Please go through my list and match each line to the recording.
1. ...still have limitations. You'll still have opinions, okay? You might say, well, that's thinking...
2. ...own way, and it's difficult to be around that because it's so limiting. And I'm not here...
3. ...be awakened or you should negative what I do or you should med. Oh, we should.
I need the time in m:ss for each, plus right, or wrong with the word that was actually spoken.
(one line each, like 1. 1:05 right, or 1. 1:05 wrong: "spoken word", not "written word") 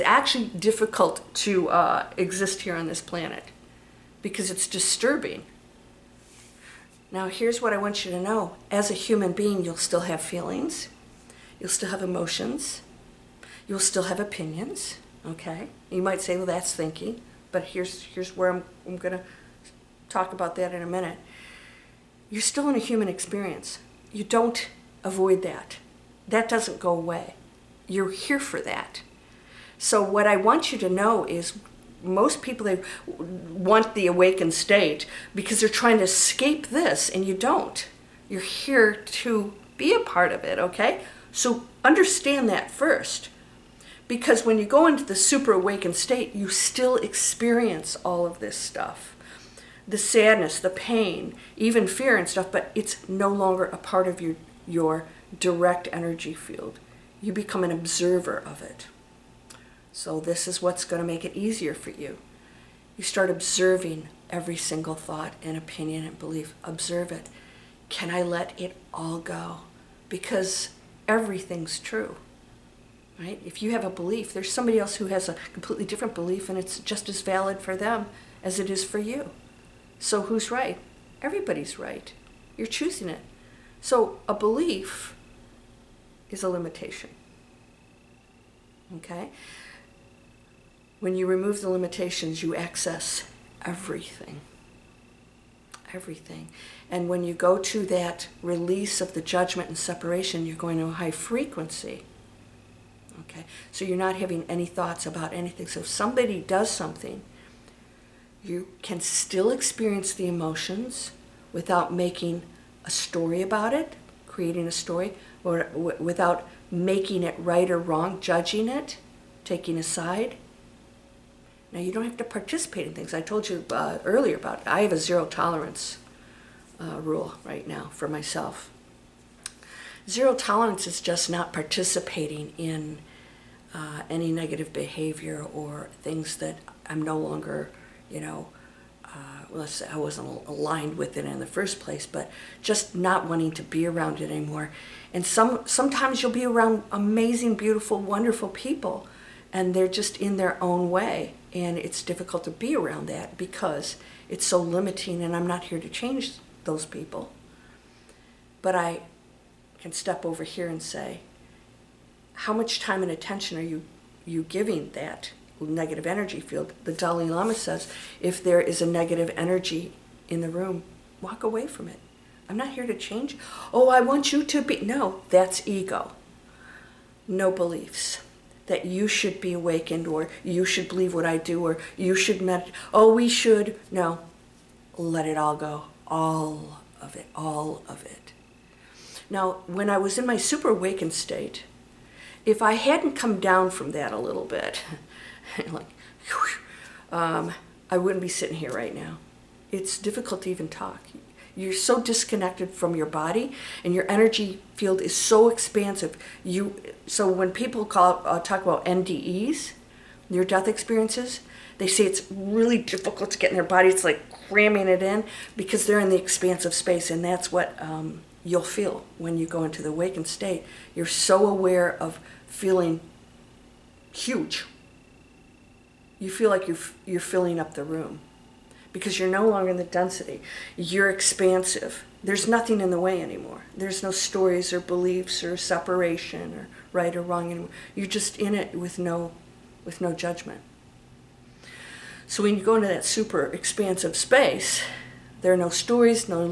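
1. 0:11 wrong: "emotions", not "limitations"
2. 2:30 right
3. 2:59 wrong: "believe", not "negative".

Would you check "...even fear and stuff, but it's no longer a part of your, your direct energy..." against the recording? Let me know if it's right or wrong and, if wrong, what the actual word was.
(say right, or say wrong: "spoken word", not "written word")
right.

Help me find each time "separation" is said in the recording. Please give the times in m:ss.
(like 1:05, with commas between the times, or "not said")
1:39, 3:55.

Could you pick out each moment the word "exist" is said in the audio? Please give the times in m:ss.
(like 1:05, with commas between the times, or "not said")
0:02.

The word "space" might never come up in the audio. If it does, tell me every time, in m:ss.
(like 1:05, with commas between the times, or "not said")
3:36, 4:04.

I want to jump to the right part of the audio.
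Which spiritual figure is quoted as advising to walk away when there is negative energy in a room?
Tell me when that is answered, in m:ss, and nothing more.
2:46.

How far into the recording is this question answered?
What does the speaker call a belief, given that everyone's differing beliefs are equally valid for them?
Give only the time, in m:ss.
1:26.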